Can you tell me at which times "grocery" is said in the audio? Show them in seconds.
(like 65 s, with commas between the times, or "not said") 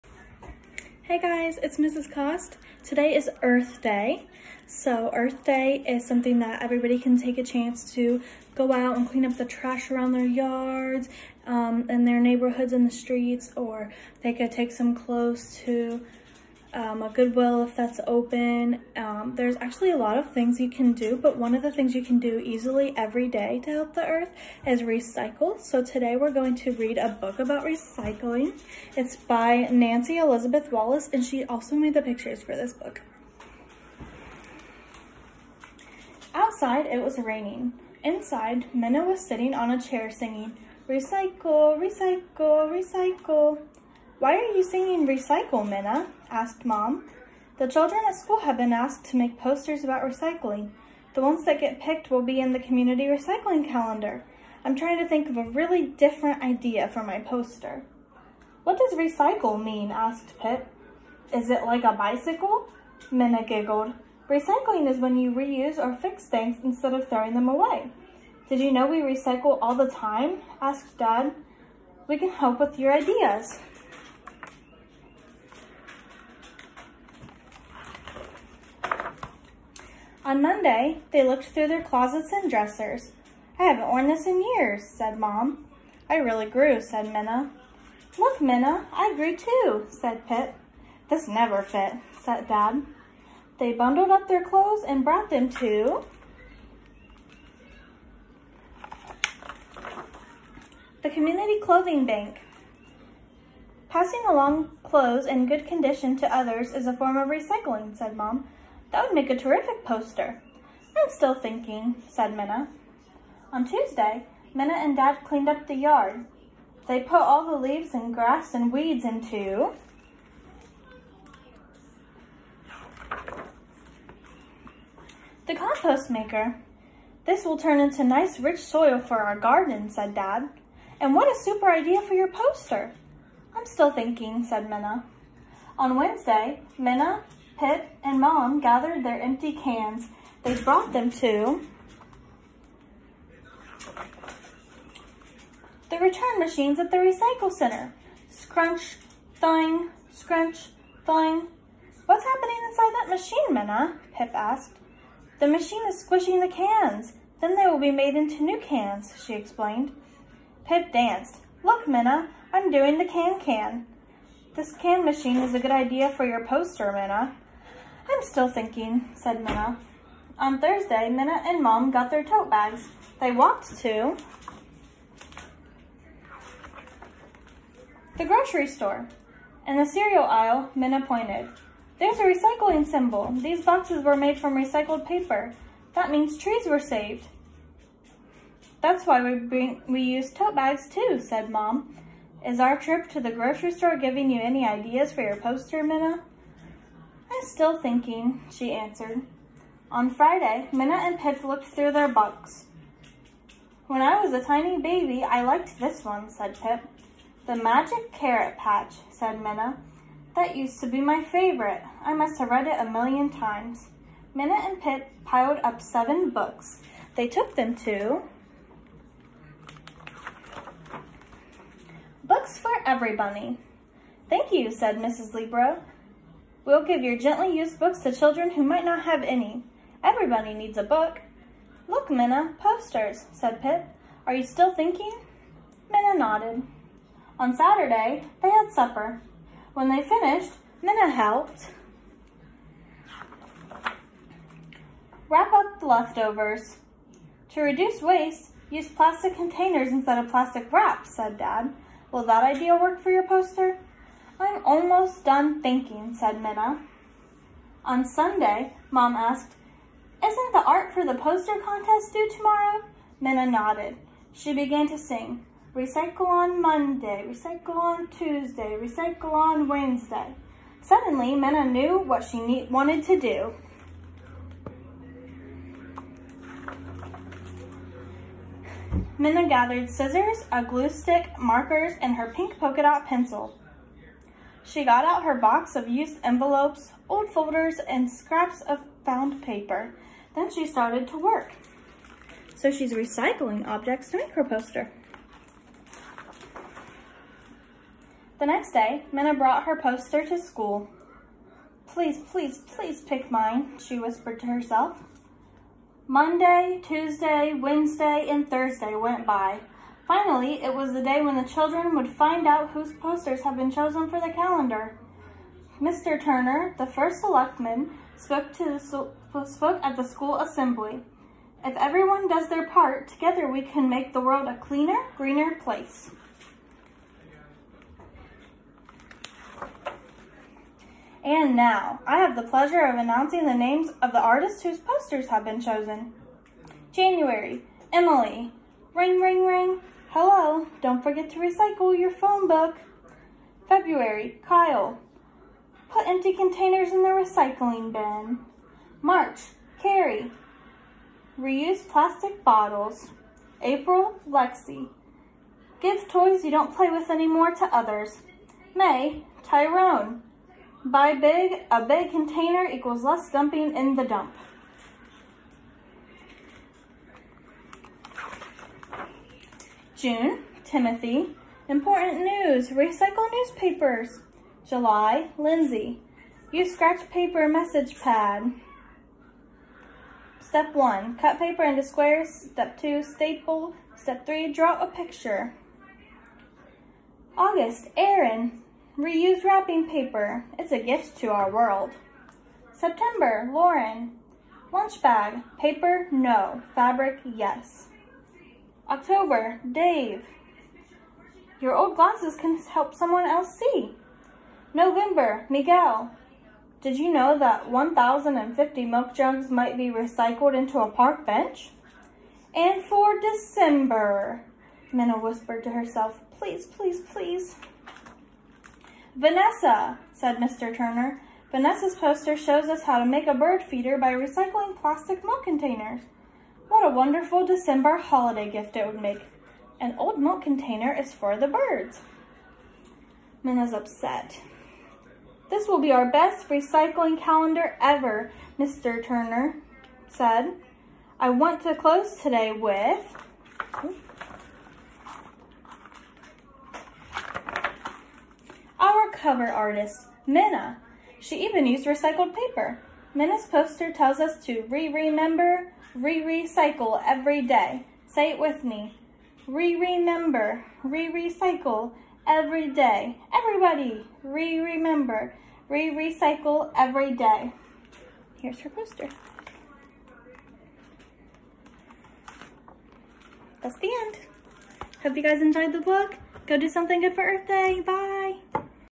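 178 s, 193 s.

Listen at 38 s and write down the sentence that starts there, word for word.
Inside, Minna was sitting on a chair singing, Recycle, recycle, recycle.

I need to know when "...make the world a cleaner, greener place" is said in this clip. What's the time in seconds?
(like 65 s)
323 s.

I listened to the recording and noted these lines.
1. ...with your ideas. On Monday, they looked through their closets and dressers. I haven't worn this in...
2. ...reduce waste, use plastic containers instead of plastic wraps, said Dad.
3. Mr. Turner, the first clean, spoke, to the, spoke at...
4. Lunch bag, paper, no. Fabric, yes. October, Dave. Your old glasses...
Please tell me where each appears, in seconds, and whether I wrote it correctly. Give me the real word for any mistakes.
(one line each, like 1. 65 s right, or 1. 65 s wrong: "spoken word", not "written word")
1. 72 s right
2. 247 s right
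3. 315 s wrong: "selectman", not "clean"
4. 394 s right.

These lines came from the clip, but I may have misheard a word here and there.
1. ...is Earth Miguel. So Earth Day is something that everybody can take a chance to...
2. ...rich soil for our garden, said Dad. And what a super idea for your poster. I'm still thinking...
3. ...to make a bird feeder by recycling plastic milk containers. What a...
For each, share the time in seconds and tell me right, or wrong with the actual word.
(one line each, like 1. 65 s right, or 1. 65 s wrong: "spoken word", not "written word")
1. 3 s wrong: "Day", not "Miguel"
2. 128 s right
3. 422 s right.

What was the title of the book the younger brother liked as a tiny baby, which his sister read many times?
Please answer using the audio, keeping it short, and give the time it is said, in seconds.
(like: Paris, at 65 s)
The Magic Carrot Patch, at 207 s.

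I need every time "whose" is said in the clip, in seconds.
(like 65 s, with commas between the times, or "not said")
312 s, 334 s.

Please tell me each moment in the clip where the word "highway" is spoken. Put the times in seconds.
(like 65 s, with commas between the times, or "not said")
not said.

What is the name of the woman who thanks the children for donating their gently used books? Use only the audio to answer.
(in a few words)
Mrs. Libro.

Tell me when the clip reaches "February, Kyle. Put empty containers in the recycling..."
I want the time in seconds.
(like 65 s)
343 s.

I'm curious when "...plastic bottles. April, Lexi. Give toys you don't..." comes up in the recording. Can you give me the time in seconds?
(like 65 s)
351 s.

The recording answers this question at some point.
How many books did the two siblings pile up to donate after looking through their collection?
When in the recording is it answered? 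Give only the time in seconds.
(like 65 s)
215 s.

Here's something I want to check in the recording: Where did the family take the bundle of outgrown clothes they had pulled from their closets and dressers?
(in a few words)
Community Clothing Bank.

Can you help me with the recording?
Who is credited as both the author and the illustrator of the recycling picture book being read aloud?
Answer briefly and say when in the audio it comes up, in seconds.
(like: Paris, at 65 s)
Nancy Elizabeth Wallace, at 29 s.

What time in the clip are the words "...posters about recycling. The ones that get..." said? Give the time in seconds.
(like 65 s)
49 s.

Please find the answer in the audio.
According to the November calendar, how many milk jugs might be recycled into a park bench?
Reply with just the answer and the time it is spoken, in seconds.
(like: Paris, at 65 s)
1,050, at 407 s.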